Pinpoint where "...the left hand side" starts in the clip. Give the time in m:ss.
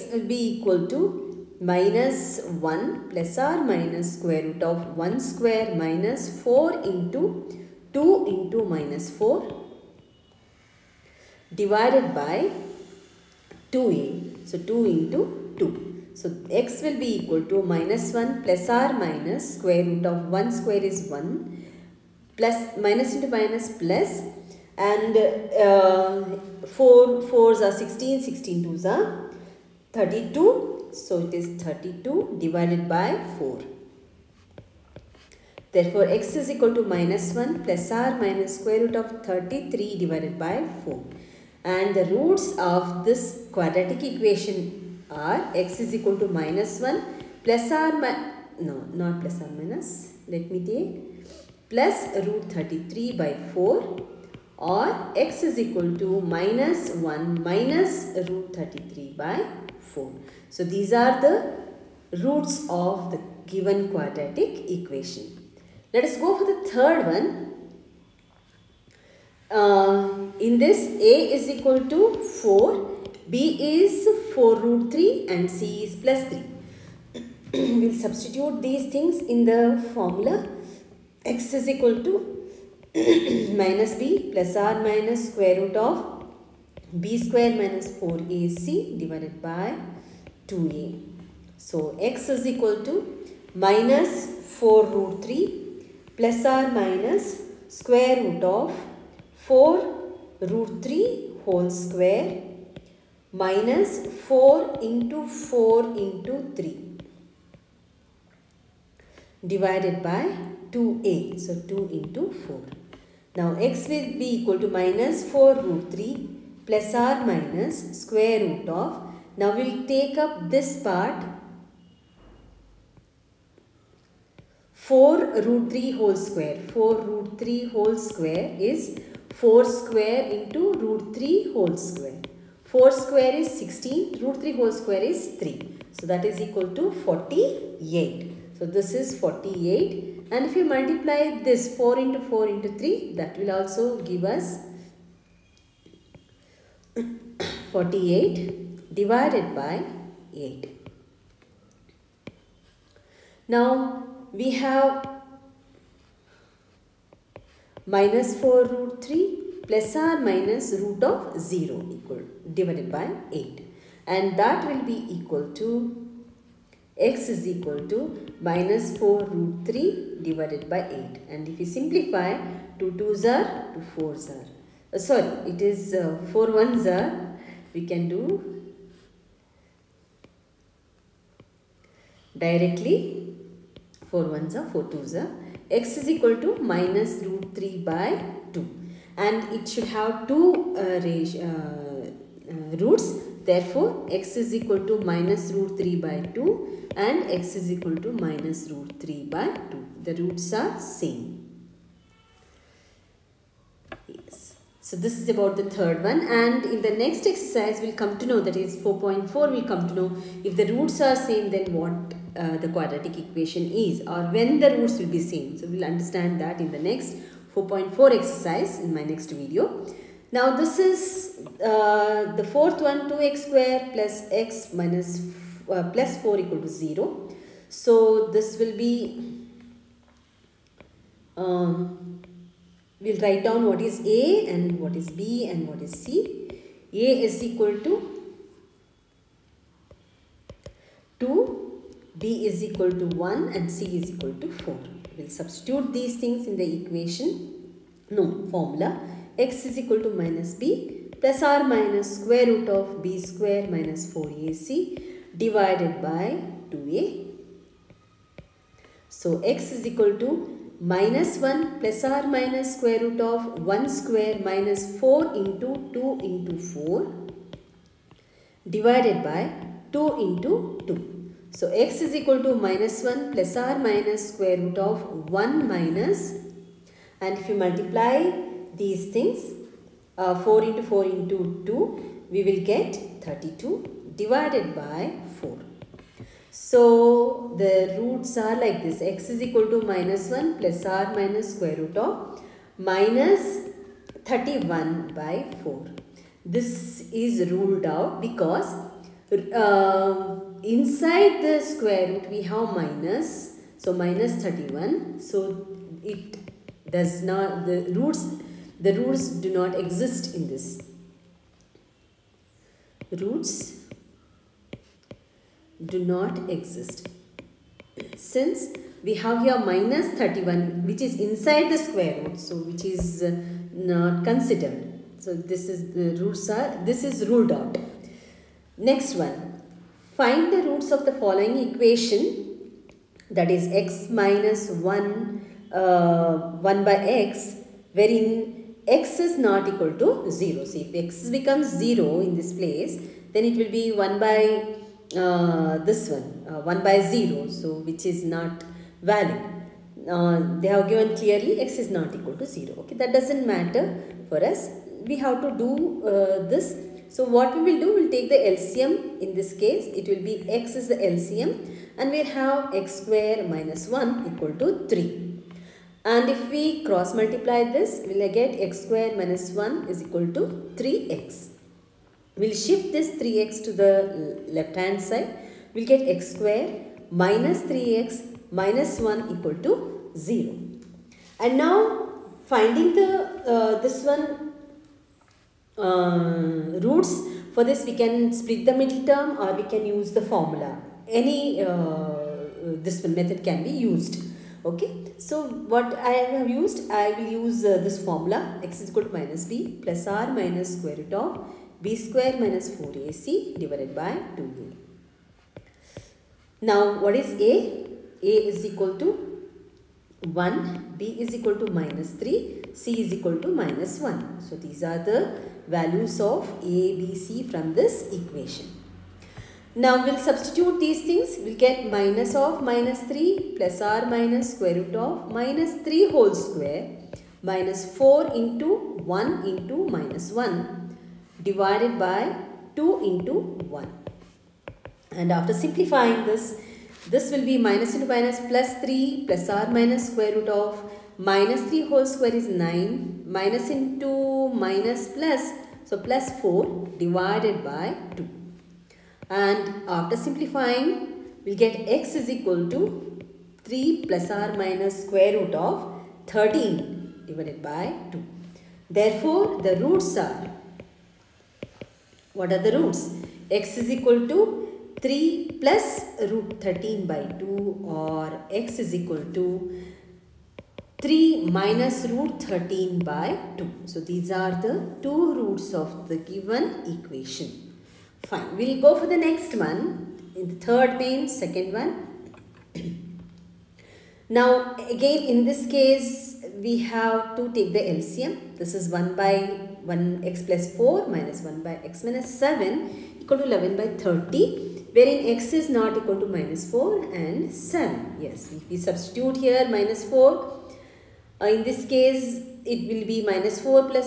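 6:13.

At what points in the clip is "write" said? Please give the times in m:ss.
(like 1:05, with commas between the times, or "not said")
3:53.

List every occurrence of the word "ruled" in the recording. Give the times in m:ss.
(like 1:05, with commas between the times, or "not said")
4:57, 5:27.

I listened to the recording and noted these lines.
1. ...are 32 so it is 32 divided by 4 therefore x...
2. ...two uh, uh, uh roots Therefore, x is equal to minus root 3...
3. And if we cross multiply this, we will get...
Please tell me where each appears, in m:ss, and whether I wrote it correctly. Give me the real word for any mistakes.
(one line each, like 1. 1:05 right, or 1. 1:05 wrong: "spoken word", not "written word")
1. 0:28 right
2. 3:10 right
3. 6:06 right.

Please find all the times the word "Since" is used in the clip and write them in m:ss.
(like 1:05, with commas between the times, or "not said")
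5:18.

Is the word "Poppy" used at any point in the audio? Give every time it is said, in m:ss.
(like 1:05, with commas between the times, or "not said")
not said.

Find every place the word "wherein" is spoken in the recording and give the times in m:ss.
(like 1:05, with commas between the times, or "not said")
5:37, 8:14.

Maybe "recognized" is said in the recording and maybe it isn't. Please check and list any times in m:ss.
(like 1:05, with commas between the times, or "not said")
not said.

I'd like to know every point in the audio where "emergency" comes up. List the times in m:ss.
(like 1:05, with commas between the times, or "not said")
not said.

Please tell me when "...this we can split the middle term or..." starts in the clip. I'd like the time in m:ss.
6:27.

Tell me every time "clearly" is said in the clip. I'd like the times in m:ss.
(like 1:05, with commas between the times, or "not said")
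5:51.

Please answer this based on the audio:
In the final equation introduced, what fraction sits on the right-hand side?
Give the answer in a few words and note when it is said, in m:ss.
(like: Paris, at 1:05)
11/30, at 8:13.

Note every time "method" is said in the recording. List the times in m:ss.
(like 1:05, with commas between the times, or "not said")
6:33.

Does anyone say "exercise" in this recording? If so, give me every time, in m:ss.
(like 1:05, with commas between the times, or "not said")
3:27, 3:38.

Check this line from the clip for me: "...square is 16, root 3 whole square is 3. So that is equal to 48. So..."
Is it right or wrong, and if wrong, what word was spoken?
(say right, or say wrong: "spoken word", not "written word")
right.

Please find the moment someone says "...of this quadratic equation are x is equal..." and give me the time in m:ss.
0:42.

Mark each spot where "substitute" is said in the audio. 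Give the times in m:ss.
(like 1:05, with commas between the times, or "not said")
1:17, 4:05, 7:00, 8:18.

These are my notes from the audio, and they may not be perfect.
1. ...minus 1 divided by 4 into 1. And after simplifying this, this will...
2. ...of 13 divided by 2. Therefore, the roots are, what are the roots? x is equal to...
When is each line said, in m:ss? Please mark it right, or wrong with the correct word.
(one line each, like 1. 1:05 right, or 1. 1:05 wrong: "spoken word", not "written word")
1. 7:09 wrong: "2", not "4"
2. 7:35 right.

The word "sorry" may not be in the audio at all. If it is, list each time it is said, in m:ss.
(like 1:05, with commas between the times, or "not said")
2:55.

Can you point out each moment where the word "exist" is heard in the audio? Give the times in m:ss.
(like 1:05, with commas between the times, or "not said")
5:09, 5:16.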